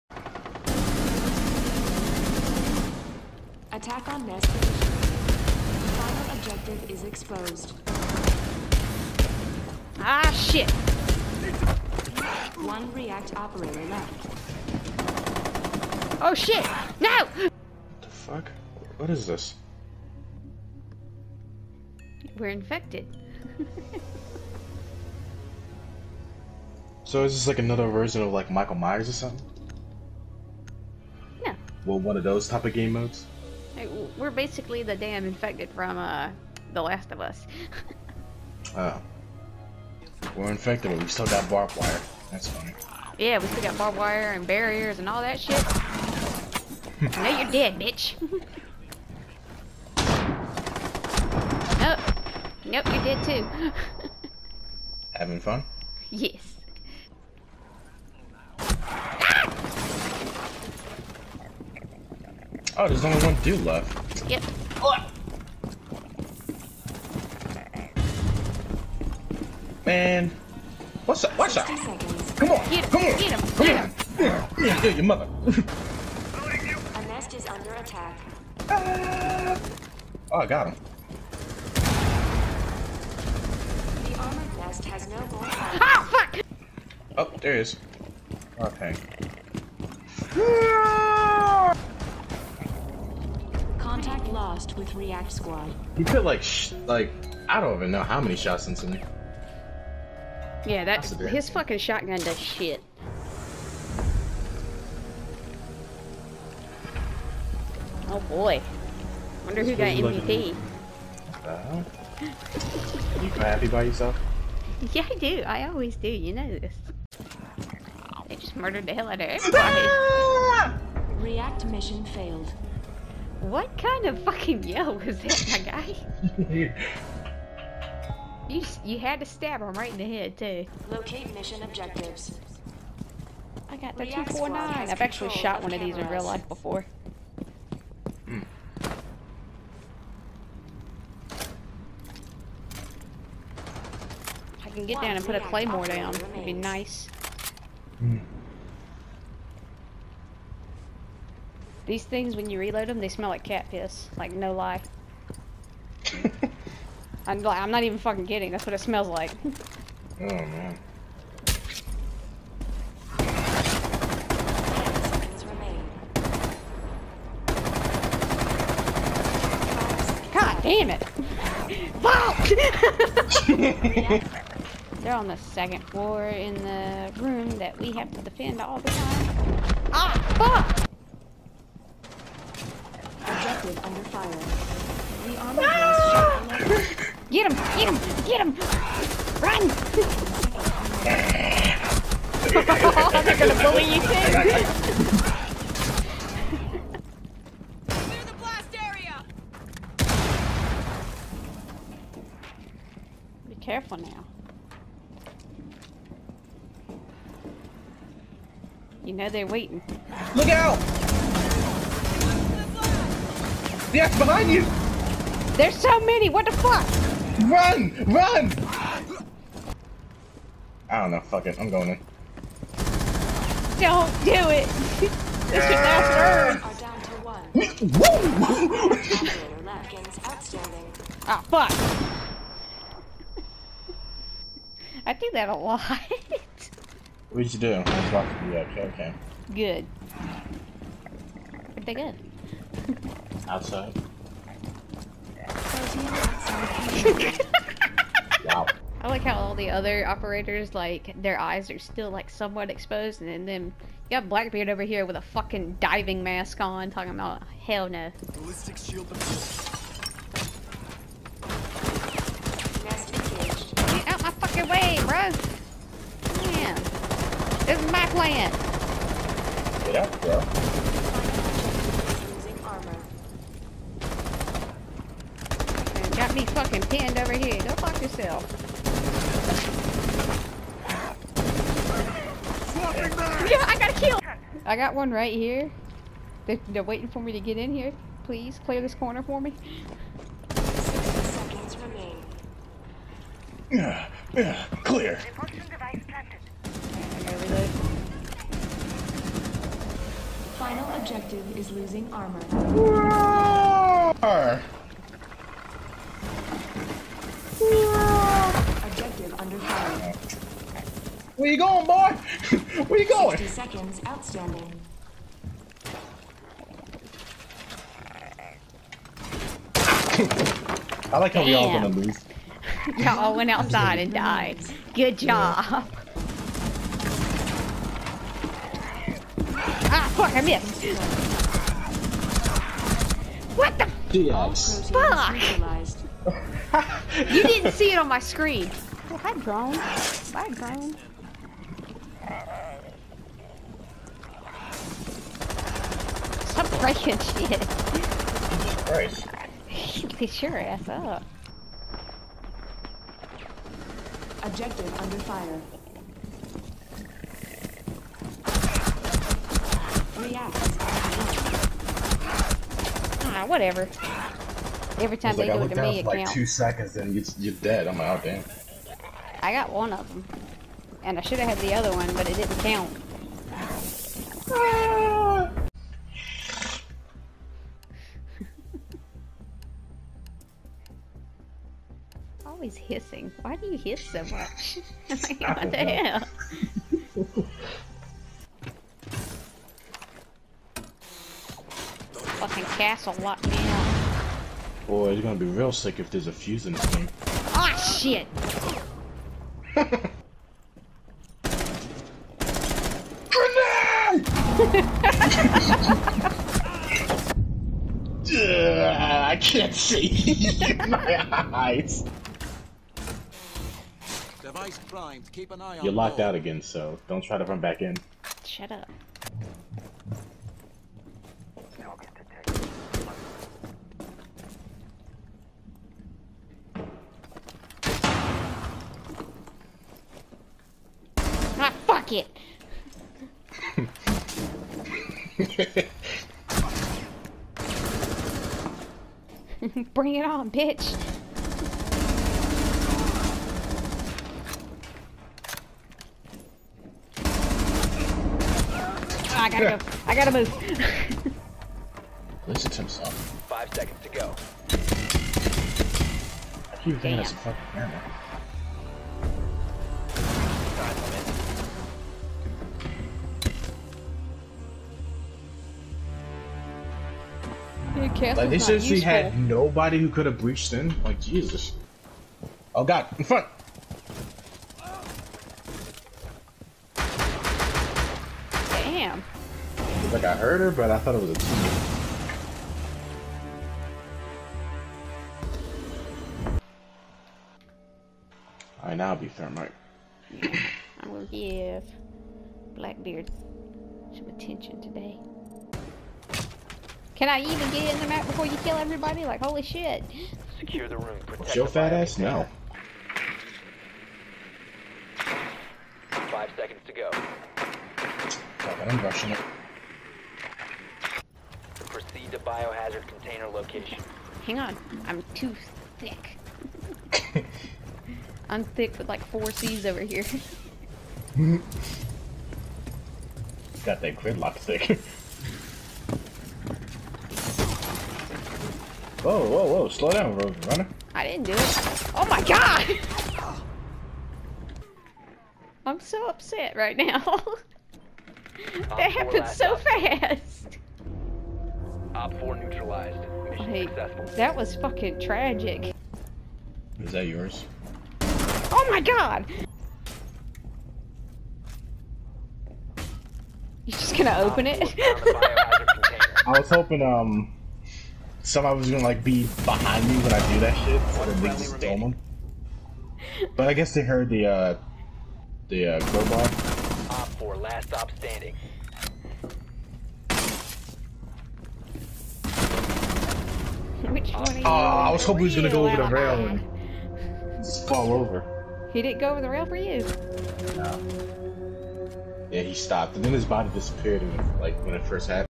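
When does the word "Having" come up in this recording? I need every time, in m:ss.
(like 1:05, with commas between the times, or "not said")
0:55.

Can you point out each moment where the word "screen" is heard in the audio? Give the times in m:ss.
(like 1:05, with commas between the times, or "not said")
5:38.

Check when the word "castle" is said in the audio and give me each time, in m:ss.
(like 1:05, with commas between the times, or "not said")
6:32.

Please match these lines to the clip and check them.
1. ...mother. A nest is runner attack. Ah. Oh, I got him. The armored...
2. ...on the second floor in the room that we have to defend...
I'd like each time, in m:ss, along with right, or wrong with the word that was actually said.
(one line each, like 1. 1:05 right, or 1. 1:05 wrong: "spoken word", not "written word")
1. 1:15 wrong: "under", not "runner"
2. 2:55 right.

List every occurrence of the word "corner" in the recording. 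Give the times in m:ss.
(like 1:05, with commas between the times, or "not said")
4:48.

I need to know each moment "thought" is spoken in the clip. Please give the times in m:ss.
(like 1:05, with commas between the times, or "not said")
8:00.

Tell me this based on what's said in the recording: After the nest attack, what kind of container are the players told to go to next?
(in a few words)
Biohazard container.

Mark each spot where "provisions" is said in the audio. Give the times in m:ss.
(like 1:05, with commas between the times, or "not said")
not said.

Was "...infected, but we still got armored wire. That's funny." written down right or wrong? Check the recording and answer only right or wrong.
wrong.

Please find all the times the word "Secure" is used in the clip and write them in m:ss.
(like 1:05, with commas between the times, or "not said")
8:20.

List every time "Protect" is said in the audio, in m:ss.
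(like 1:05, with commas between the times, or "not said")
8:21.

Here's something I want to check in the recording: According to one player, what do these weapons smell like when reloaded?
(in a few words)
Cat piss.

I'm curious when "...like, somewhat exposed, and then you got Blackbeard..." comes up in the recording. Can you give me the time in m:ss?
4:12.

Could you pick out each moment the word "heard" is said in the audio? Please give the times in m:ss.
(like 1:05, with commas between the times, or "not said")
8:00, 9:24.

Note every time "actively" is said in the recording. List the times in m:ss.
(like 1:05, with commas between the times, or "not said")
not said.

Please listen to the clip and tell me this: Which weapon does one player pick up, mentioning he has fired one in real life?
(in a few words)
249.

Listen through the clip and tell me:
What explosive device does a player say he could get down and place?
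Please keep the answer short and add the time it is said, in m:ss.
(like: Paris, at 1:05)
Claymore, at 2:25.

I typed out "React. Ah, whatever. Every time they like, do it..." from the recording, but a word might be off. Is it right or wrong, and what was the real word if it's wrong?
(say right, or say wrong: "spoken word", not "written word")
right.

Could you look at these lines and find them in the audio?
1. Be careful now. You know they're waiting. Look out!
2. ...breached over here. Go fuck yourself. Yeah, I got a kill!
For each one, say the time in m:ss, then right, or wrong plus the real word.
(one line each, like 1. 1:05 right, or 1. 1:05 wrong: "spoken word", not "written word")
1. 3:23 right
2. 4:36 wrong: "pinned", not "breached".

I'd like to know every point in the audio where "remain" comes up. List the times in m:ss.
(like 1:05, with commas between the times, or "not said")
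4:51.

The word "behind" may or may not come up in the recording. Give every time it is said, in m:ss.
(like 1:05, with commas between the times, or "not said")
3:34, 9:19.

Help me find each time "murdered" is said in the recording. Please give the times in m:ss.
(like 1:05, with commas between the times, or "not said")
1:58.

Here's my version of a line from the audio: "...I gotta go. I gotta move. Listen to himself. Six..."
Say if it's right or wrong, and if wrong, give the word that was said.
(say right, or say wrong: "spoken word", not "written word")
wrong: "Five", not "Six".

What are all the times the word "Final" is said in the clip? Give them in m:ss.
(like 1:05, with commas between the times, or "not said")
0:04, 5:00.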